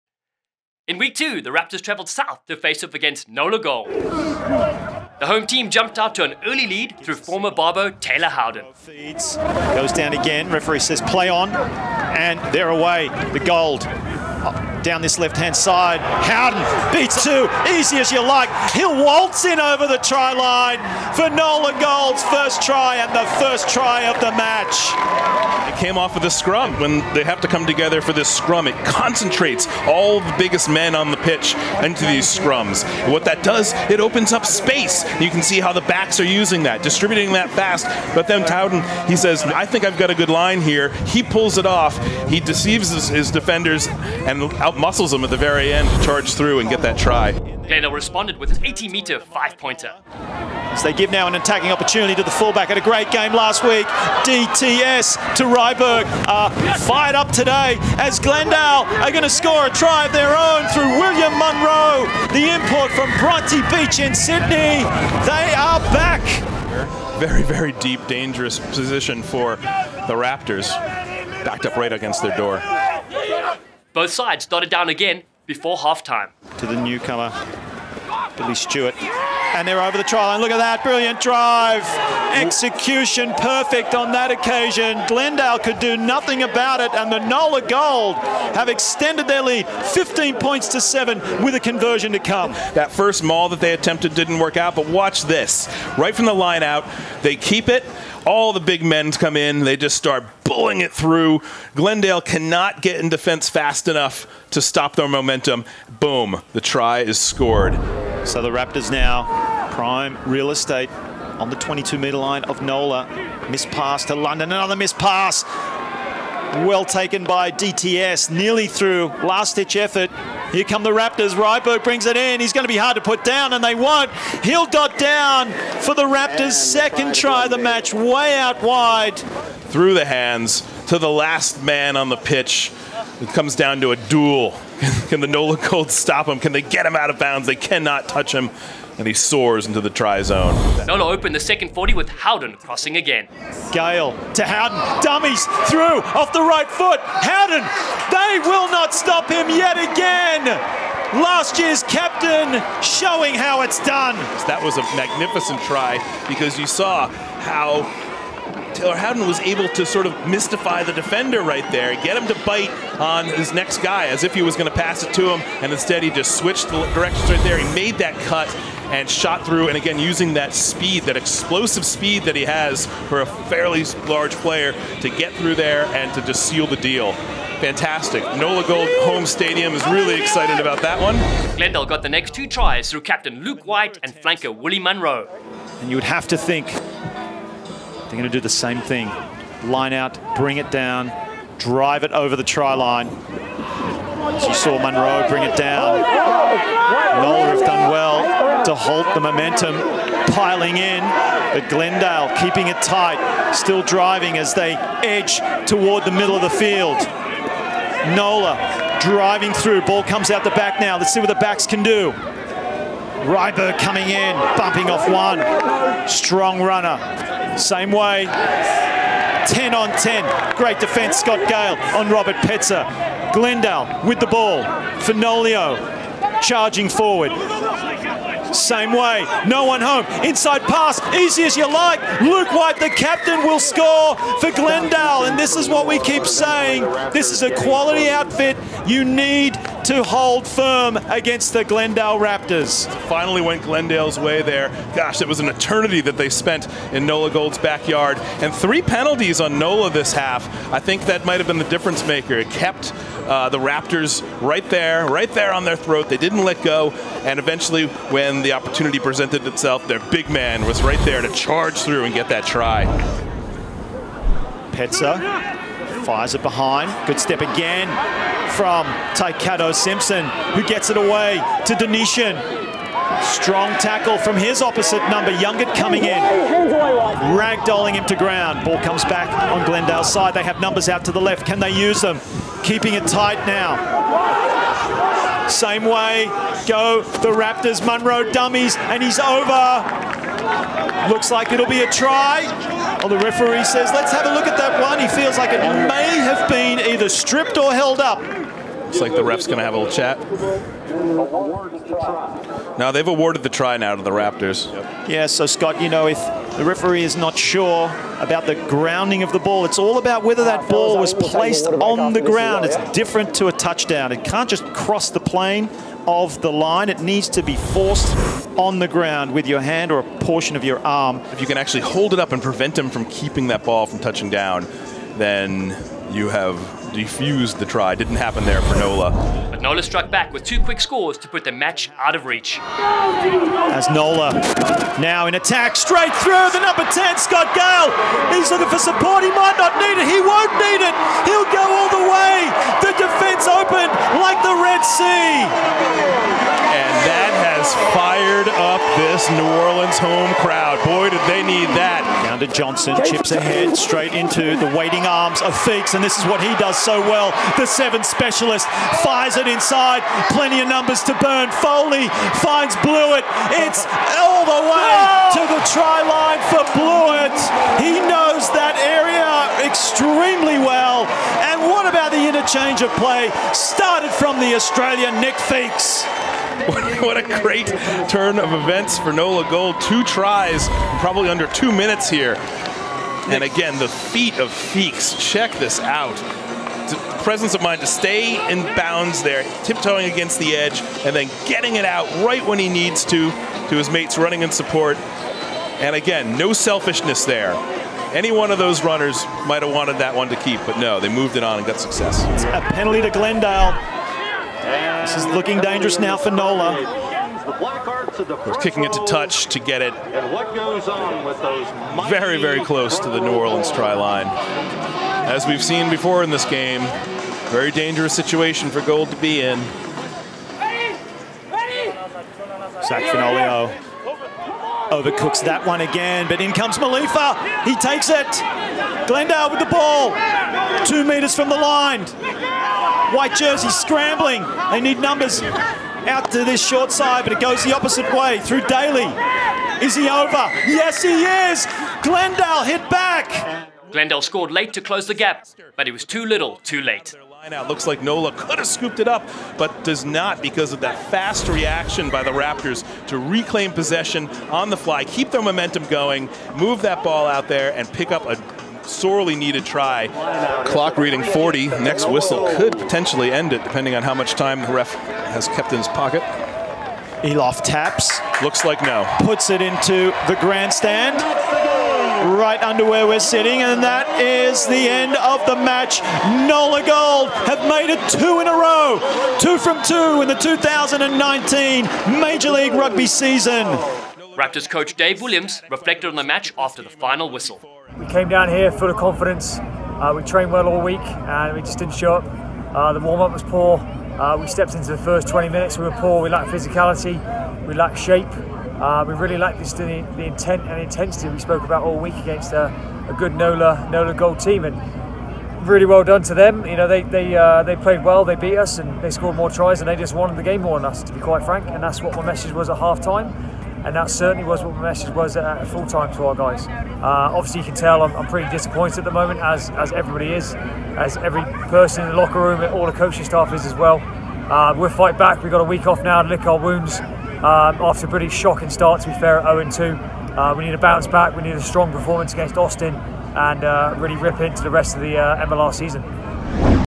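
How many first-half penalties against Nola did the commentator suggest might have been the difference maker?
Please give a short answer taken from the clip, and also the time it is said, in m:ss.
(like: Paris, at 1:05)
3, at 4:08.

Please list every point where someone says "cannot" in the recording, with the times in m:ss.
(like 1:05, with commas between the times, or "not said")
1:42, 2:17.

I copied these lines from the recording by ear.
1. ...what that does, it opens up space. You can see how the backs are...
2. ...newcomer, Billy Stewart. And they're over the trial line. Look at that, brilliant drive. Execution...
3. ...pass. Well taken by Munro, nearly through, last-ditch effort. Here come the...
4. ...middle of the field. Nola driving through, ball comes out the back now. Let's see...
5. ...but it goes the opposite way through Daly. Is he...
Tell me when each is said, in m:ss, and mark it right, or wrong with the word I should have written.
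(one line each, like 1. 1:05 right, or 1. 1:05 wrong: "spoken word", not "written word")
1. 0:33 right
2. 1:16 right
3. 1:54 wrong: "DTS", not "Munro"
4. 3:26 right
5. 7:17 right.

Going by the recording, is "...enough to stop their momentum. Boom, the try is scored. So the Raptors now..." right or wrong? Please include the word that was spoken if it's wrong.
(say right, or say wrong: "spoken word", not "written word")
right.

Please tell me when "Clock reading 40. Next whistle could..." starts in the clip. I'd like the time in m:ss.
7:40.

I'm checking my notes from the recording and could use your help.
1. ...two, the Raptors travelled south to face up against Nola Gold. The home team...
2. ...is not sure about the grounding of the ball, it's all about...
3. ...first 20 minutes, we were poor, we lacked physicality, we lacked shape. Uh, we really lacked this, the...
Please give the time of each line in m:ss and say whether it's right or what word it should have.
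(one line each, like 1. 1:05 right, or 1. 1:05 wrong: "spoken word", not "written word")
1. 0:01 right
2. 5:07 right
3. 8:14 right.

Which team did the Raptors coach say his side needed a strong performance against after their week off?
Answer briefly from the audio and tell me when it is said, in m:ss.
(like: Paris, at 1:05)
Austin, at 8:52.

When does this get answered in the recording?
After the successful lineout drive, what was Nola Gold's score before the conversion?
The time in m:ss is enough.
1:29.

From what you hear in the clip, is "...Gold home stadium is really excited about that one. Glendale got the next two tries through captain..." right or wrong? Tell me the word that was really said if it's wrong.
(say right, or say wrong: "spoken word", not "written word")
right.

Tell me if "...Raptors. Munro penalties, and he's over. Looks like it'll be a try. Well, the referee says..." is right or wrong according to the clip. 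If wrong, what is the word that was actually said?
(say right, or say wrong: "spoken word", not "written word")
wrong: "dummies", not "penalties".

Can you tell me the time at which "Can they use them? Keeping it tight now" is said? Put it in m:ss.
4:41.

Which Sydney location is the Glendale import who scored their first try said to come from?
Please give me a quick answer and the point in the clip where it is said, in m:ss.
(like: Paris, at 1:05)
Bronte Beach, at 1:03.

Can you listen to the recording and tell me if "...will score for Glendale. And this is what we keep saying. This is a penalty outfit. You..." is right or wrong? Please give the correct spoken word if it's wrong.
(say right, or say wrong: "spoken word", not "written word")
wrong: "quality", not "penalty".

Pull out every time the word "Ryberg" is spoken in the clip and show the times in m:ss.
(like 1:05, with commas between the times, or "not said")
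0:55, 2:01, 3:33.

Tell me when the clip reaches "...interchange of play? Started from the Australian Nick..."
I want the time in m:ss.
6:12.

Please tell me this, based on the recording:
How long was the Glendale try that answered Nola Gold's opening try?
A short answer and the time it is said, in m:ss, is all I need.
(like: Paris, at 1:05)
80 meters, at 0:48.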